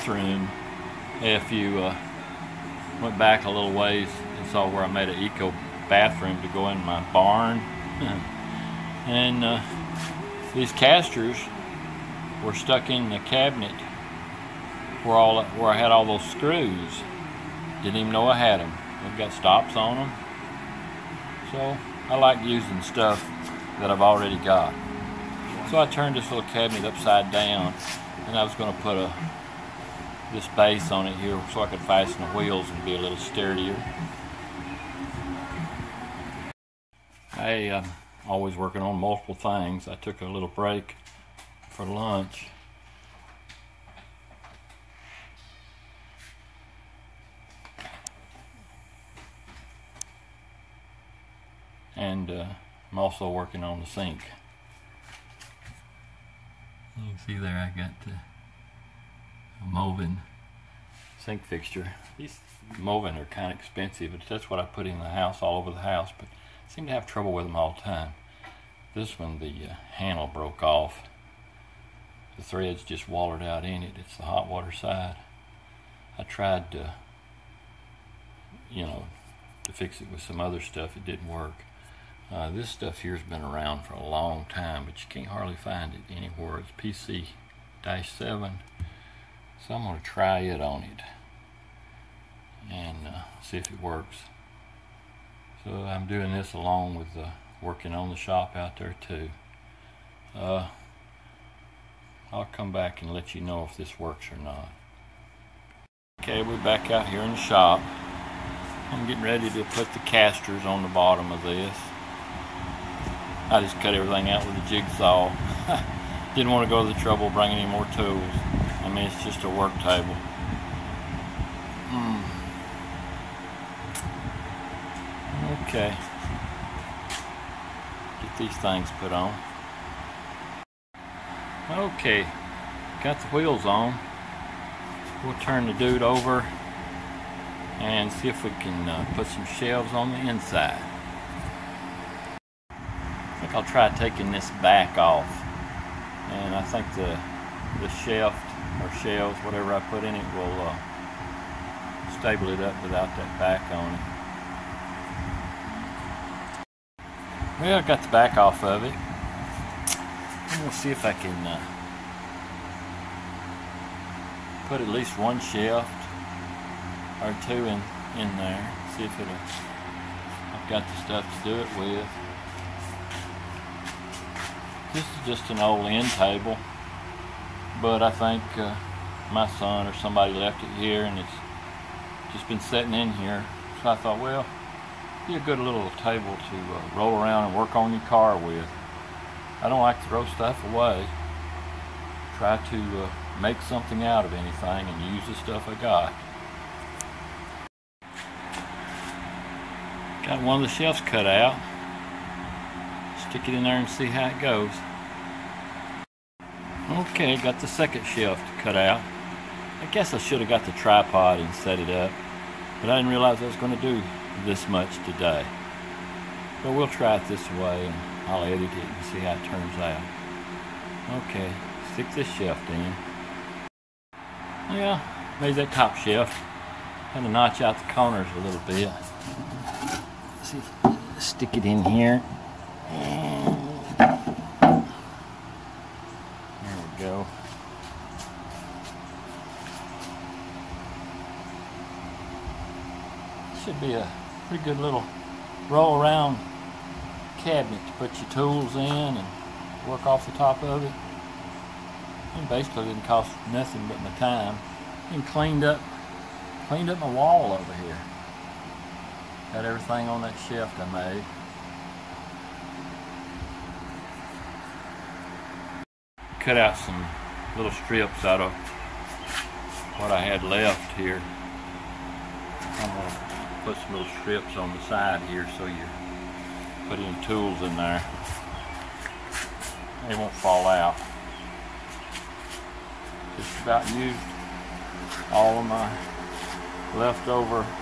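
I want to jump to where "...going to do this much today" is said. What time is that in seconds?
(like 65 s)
213 s.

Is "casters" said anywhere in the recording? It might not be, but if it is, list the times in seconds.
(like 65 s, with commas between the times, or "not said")
10 s, 110 s.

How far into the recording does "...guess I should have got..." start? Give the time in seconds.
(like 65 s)
209 s.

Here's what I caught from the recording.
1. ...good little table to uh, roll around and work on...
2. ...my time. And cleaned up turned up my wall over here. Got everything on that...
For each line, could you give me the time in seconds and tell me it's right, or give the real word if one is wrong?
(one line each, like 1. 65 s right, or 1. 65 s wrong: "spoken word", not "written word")
1. 185 s right
2. 254 s wrong: "cleaned", not "turned".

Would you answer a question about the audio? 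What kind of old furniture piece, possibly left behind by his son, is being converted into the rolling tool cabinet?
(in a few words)
end table.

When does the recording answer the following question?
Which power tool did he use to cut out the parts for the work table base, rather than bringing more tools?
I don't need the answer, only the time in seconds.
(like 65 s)
114 s.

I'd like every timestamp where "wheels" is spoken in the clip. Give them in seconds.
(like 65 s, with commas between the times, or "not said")
32 s, 133 s.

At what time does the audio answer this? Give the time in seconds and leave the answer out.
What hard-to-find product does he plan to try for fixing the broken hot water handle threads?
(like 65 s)
87 s.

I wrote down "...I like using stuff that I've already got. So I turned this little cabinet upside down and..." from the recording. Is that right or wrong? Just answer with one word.
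right.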